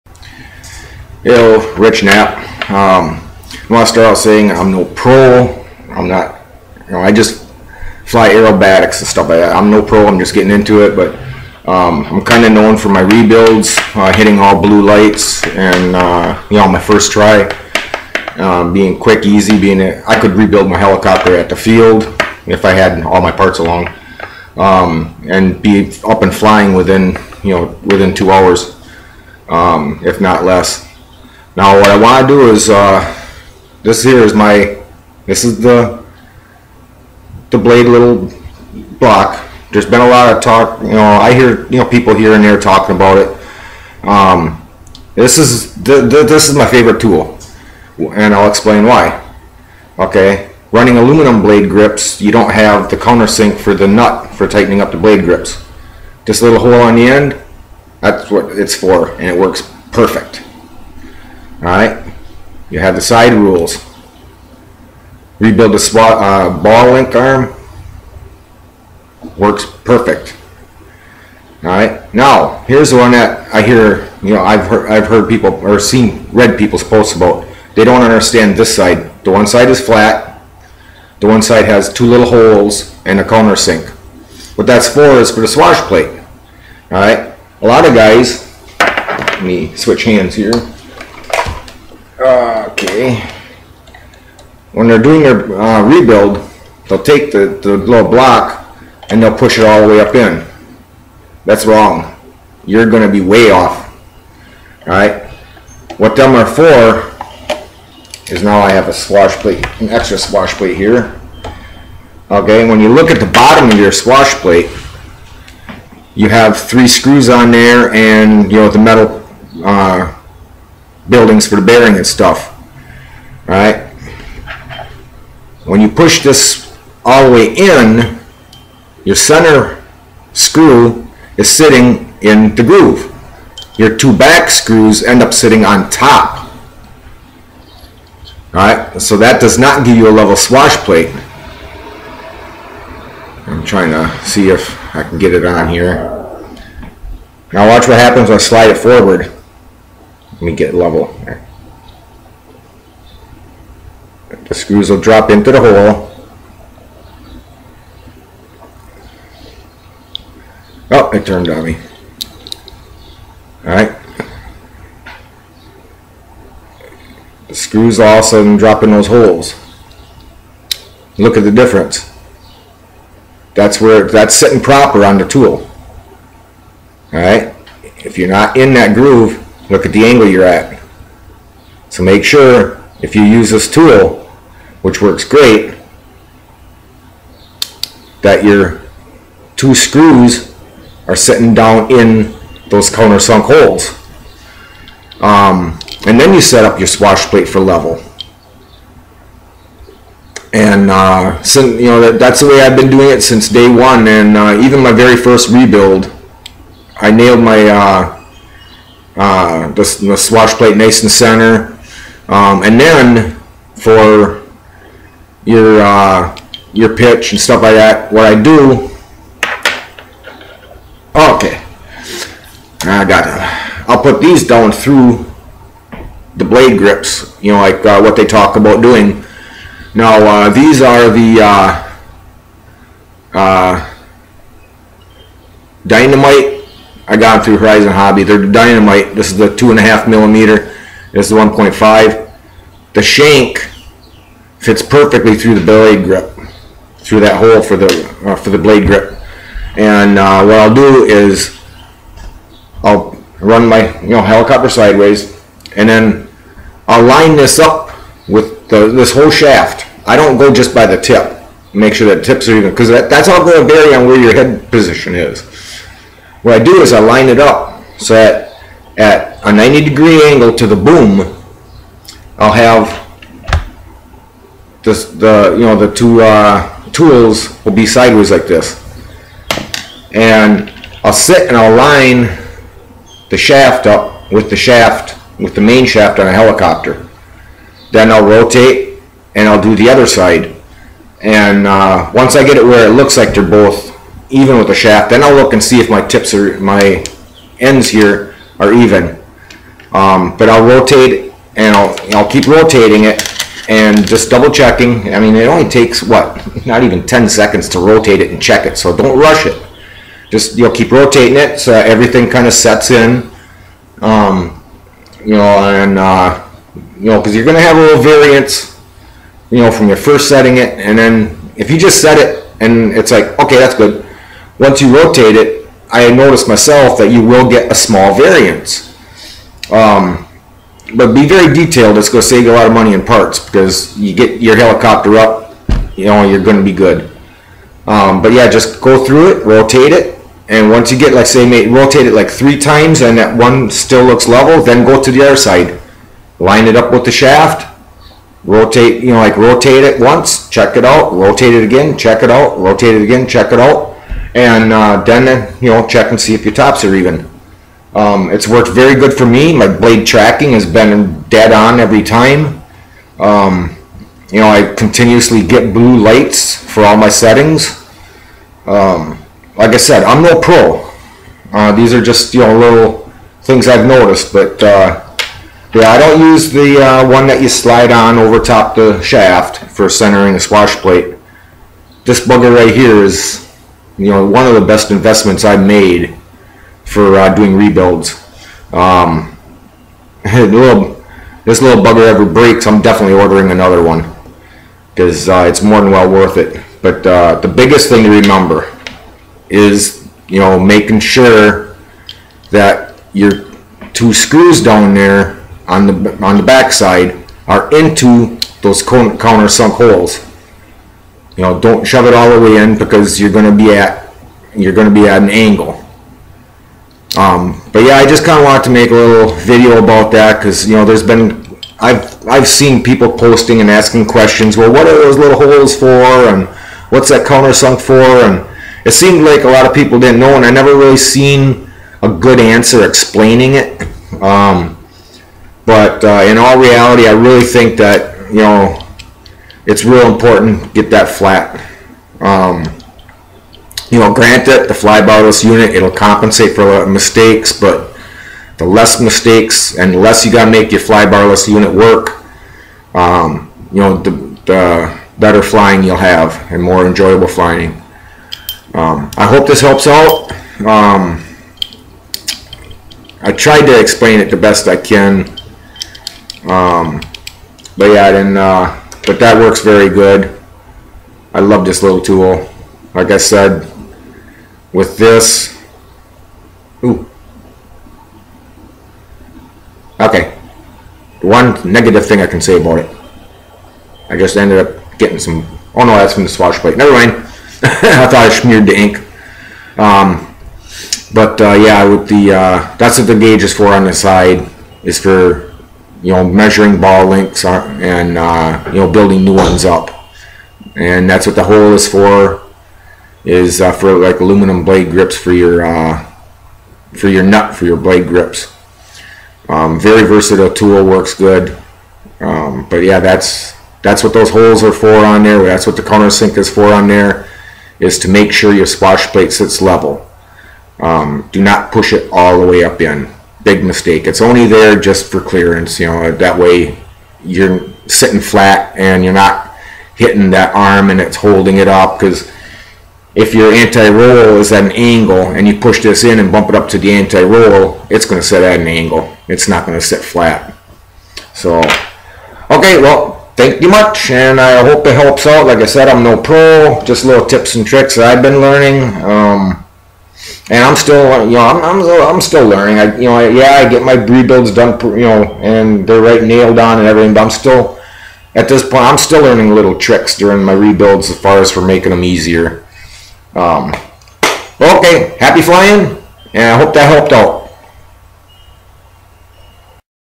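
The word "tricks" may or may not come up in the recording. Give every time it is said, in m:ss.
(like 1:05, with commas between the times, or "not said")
9:07, 9:19.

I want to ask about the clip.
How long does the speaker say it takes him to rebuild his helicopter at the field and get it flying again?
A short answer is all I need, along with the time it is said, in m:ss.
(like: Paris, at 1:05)
2 hours, at 0:28.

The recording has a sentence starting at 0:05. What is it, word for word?
I'm not, you know, I just fly aerobatics and stuff like that.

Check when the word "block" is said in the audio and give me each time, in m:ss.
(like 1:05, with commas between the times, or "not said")
0:38, 1:38.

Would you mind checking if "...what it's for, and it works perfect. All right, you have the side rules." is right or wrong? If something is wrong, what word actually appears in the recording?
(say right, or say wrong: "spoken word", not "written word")
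right.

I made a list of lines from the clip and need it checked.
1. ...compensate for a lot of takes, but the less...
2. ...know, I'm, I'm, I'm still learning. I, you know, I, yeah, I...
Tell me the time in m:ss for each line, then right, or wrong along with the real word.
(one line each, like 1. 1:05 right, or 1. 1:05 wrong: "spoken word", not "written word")
1. 7:25 wrong: "mistakes", not "takes"
2. 9:11 right.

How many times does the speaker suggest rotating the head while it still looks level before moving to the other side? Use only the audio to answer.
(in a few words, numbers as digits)
3 times.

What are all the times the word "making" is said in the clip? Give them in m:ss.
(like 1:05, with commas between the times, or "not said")
6:40, 9:21.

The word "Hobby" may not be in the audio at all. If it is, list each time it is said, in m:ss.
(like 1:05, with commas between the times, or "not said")
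3:57.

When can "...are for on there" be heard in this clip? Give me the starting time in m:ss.
8:34.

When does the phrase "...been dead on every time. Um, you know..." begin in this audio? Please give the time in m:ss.
6:00.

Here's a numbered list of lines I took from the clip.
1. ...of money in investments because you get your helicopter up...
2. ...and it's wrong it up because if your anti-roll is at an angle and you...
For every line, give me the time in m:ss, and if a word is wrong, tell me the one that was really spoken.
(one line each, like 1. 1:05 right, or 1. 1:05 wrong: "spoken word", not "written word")
1. 5:32 wrong: "parts", not "investments"
2. 8:50 wrong: "holding", not "wrong".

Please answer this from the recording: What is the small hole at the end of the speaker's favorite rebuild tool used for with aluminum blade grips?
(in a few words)
Countersink for the nut.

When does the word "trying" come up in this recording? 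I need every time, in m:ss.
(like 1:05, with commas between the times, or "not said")
2:23.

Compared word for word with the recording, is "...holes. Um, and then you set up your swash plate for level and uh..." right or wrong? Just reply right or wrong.
right.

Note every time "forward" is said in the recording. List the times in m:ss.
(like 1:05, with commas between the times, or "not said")
2:28.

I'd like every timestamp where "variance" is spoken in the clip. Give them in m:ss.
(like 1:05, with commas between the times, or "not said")
5:18, 5:28.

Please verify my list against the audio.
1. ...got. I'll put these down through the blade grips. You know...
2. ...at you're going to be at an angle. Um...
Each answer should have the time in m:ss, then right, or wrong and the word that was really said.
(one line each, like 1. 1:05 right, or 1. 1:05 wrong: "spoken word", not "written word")
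1. 3:43 right
2. 6:53 right.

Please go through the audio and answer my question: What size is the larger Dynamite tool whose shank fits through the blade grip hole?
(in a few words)
2.5 millimeter.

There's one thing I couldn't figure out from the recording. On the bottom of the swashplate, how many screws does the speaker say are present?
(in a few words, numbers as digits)
3.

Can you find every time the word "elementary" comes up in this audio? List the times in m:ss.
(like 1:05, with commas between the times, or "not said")
not said.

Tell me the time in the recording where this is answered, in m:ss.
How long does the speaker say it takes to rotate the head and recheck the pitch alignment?
5:06.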